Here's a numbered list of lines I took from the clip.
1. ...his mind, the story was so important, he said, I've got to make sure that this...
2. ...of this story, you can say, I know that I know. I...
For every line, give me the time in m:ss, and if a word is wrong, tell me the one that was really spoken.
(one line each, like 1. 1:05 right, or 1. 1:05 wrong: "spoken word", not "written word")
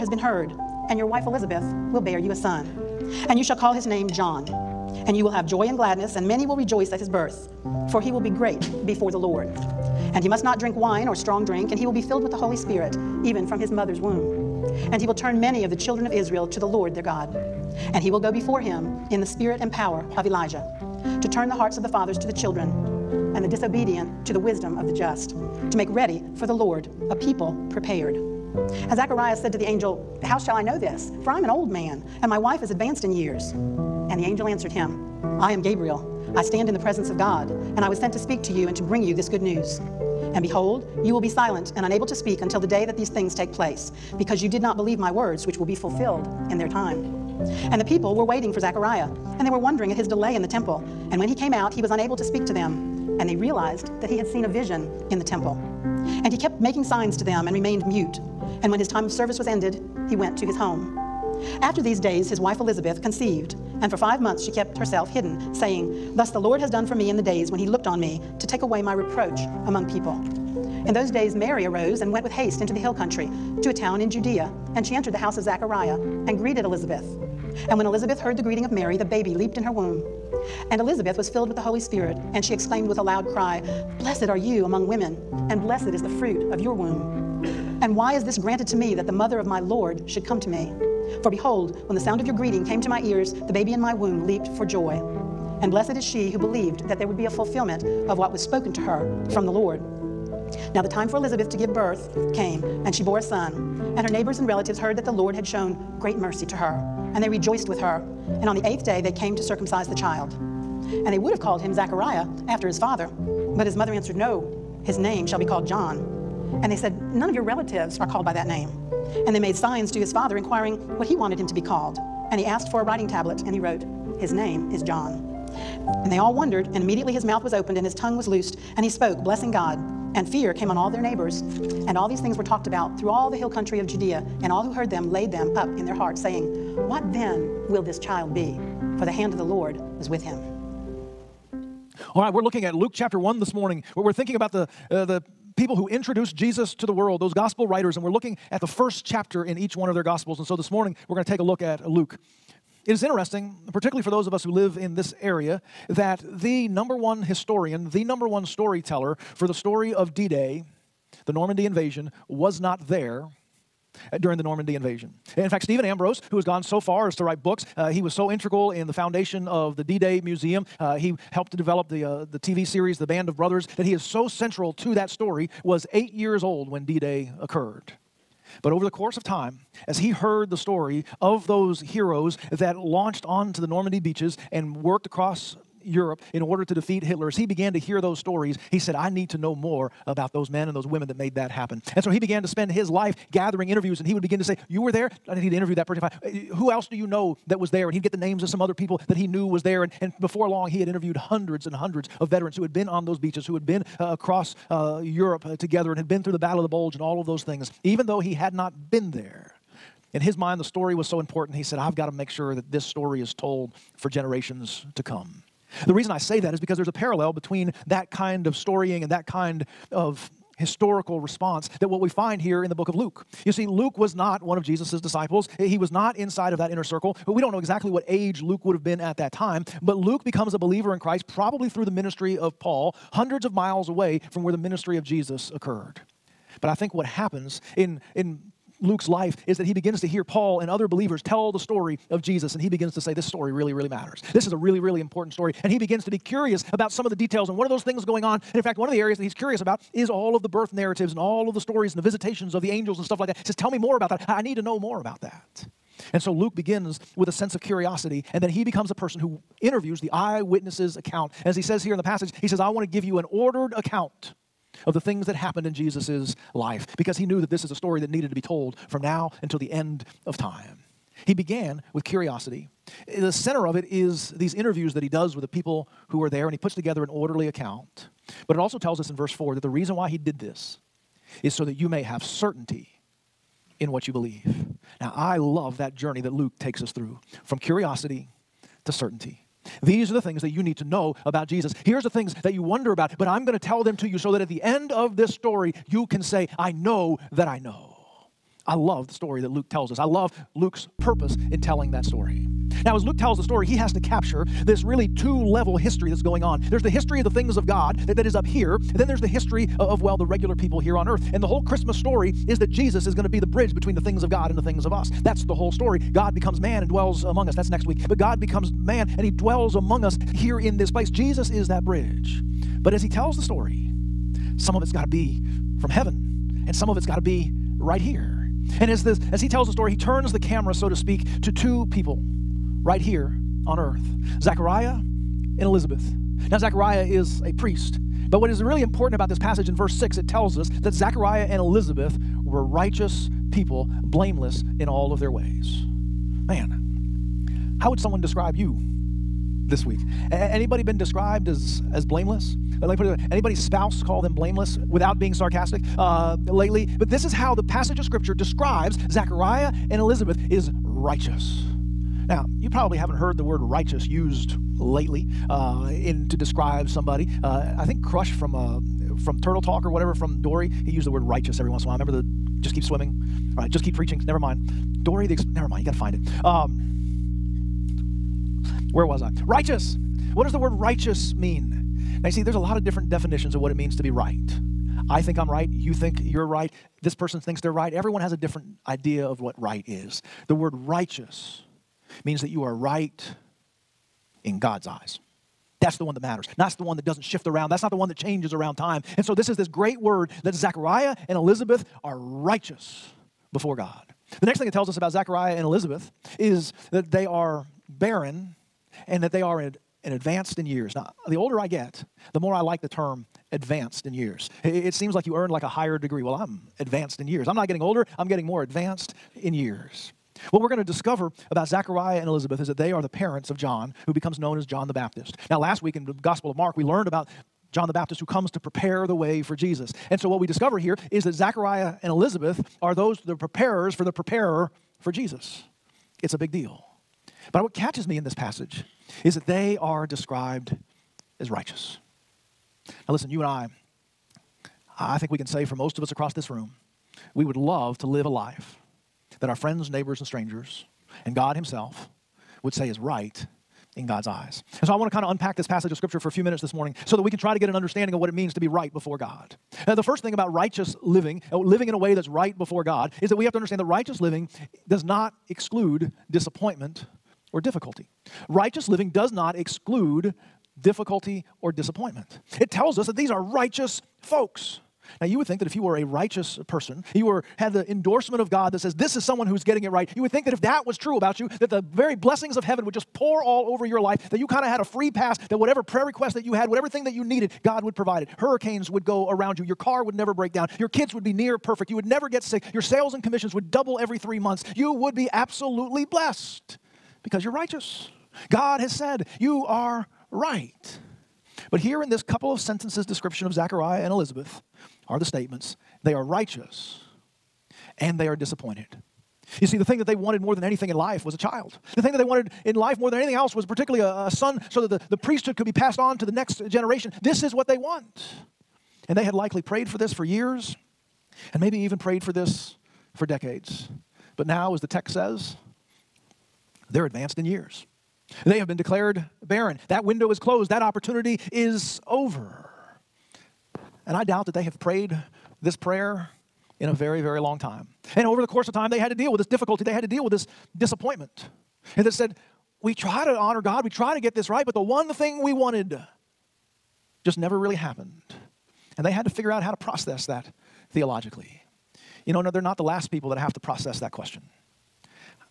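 1. 3:30 right
2. 4:54 right.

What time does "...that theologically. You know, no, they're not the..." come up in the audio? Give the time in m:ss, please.
9:10.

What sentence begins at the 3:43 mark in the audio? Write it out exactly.
You see, Luke was not one of Jesus' disciples.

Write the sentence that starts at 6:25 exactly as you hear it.
You think you're right this person thinks they're right.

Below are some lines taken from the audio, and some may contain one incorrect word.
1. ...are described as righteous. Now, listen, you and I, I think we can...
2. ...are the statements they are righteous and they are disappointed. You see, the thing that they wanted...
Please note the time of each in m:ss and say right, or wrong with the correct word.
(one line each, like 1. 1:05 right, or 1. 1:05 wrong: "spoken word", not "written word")
1. 7:19 right
2. 8:25 right.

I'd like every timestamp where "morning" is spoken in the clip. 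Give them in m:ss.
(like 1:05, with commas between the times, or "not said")
2:23, 2:30, 7:36.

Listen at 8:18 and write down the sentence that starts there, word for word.
God has said, You are right.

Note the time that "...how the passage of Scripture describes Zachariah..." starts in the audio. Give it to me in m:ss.
5:57.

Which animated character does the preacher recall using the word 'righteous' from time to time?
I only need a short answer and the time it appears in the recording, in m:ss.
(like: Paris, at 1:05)
Crush, at 6:08.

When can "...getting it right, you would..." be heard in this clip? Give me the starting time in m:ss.
7:59.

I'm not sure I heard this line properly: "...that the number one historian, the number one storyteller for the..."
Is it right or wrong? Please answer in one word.
right.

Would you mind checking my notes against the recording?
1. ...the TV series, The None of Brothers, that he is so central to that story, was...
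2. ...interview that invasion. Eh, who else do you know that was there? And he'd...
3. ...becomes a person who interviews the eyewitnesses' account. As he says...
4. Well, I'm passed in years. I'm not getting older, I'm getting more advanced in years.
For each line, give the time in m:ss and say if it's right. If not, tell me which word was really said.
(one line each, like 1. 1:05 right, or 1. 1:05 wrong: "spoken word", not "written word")
1. 2:52 wrong: "Band", not "None"
2. 3:15 wrong: "person", not "invasion"
3. 4:18 right
4. 6:56 wrong: "advanced", not "passed".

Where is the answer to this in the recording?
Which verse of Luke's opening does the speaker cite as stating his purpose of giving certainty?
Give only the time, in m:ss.
4:39.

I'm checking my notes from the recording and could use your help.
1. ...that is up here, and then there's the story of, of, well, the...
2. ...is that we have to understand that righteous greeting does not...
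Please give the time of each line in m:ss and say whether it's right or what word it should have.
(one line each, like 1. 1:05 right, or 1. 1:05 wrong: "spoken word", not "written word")
1. 5:08 wrong: "history", not "story"
2. 7:43 wrong: "living", not "greeting".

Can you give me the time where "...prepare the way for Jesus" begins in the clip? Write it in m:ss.
7:08.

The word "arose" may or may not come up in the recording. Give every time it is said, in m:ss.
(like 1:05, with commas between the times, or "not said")
1:11.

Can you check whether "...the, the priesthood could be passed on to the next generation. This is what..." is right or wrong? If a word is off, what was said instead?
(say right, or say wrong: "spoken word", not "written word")
right.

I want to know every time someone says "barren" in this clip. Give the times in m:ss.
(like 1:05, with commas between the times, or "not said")
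6:47, 8:49.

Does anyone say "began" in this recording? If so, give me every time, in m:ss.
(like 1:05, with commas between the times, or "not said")
3:07, 3:12, 4:31.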